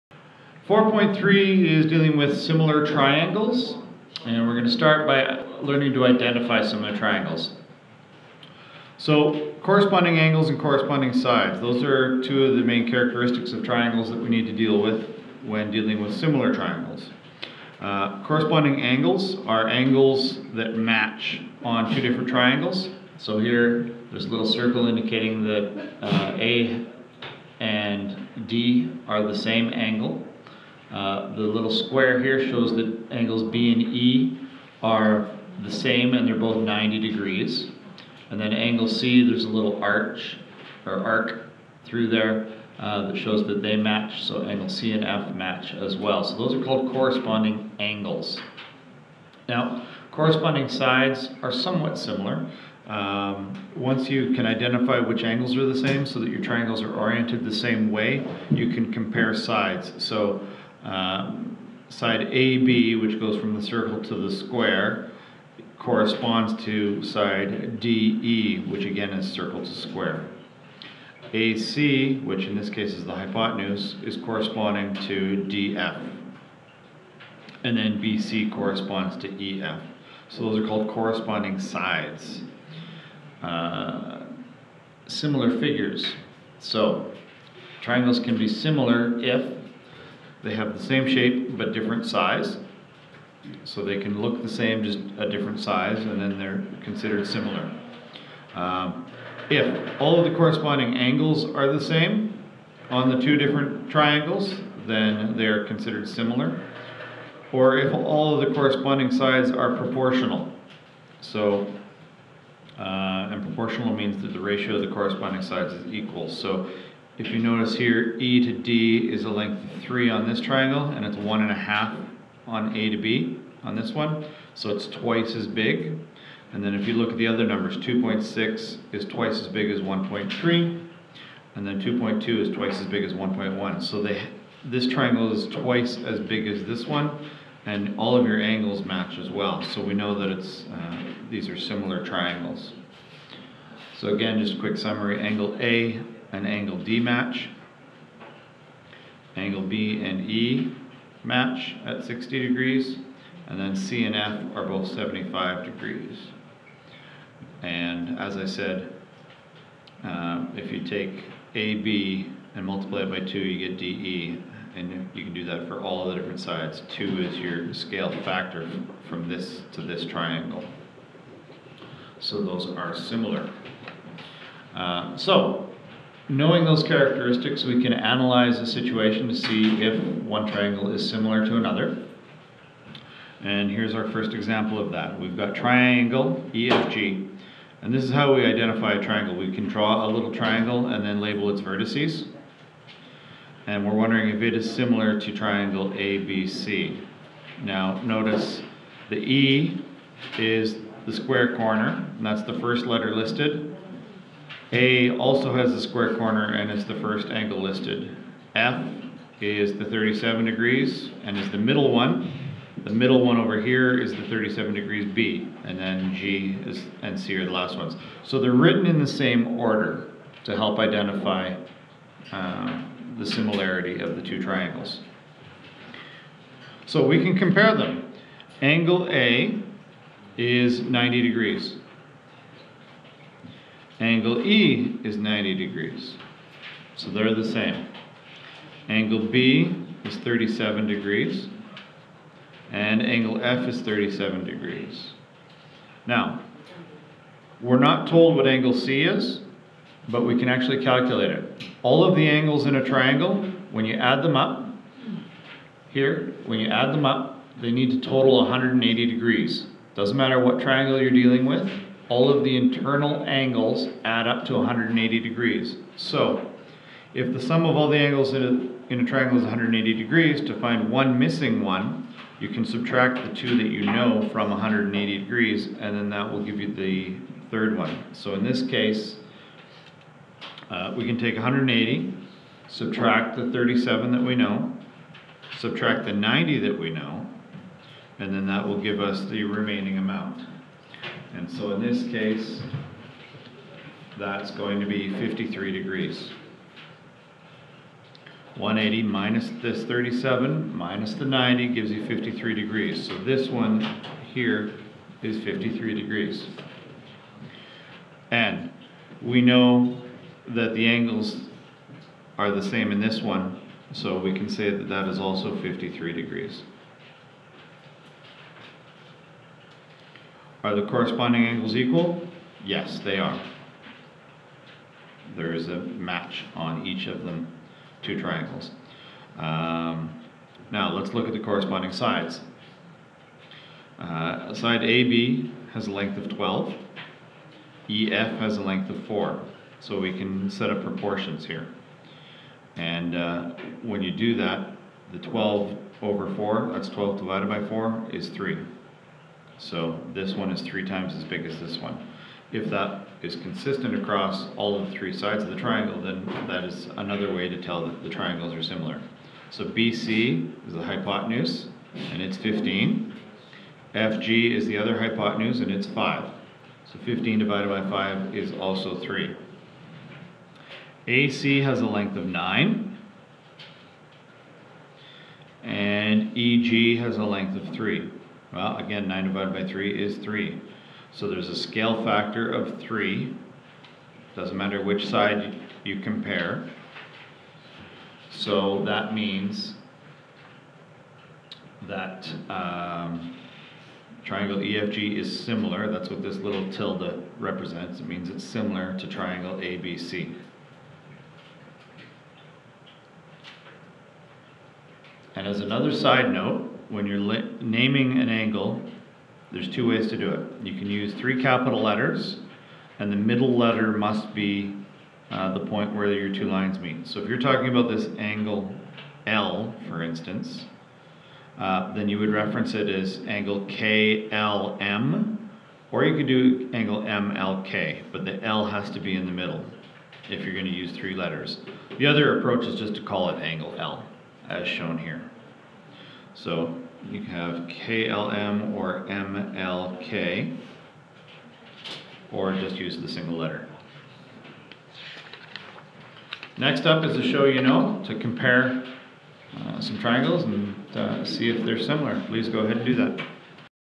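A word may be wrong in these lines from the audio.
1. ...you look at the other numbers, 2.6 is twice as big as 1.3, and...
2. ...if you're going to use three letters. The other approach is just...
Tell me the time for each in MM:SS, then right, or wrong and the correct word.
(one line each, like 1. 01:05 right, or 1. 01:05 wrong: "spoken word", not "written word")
1. 02:06 right
2. 07:10 right.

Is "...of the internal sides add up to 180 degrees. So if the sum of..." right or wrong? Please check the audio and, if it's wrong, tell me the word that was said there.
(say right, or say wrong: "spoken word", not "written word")
wrong: "angles", not "sides".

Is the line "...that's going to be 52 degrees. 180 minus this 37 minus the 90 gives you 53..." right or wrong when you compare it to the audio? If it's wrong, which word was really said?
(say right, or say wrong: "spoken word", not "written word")
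wrong: "53", not "52".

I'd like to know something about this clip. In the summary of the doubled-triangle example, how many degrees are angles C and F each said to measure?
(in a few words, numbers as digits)
75 degrees.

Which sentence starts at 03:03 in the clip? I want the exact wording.
And here's our first example of that.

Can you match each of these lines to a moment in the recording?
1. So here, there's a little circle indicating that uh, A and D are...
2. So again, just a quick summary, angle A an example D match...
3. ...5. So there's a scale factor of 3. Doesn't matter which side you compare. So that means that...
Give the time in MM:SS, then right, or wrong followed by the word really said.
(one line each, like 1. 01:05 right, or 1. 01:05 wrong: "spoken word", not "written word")
1. 00:23 right
2. 02:23 wrong: "angle", not "example"
3. 06:20 wrong: "3", not "5".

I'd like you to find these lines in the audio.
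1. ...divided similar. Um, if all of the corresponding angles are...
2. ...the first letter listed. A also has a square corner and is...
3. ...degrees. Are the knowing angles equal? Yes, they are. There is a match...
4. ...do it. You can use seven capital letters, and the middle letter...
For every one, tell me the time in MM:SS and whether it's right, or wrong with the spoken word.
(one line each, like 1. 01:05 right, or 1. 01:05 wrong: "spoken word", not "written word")
1. 01:36 wrong: "considered", not "divided"
2. 03:22 right
3. 05:16 wrong: "corresponding", not "knowing"
4. 06:50 wrong: "three", not "seven".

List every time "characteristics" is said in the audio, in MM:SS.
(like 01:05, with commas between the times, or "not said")
00:12, 02:56.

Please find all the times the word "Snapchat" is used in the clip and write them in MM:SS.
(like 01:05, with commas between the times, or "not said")
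not said.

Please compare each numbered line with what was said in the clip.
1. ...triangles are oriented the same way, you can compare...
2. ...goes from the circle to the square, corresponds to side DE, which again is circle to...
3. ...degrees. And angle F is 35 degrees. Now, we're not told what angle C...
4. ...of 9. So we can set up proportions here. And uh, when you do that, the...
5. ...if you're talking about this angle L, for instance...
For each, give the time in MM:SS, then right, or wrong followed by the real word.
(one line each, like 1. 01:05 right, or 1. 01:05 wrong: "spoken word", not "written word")
1. 00:56 right
2. 01:03 right
3. 04:00 wrong: "37", not "35"
4. 05:38 wrong: "4", not "9"
5. 06:57 right.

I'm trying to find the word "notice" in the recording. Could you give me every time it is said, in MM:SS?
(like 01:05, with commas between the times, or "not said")
01:57, 03:18.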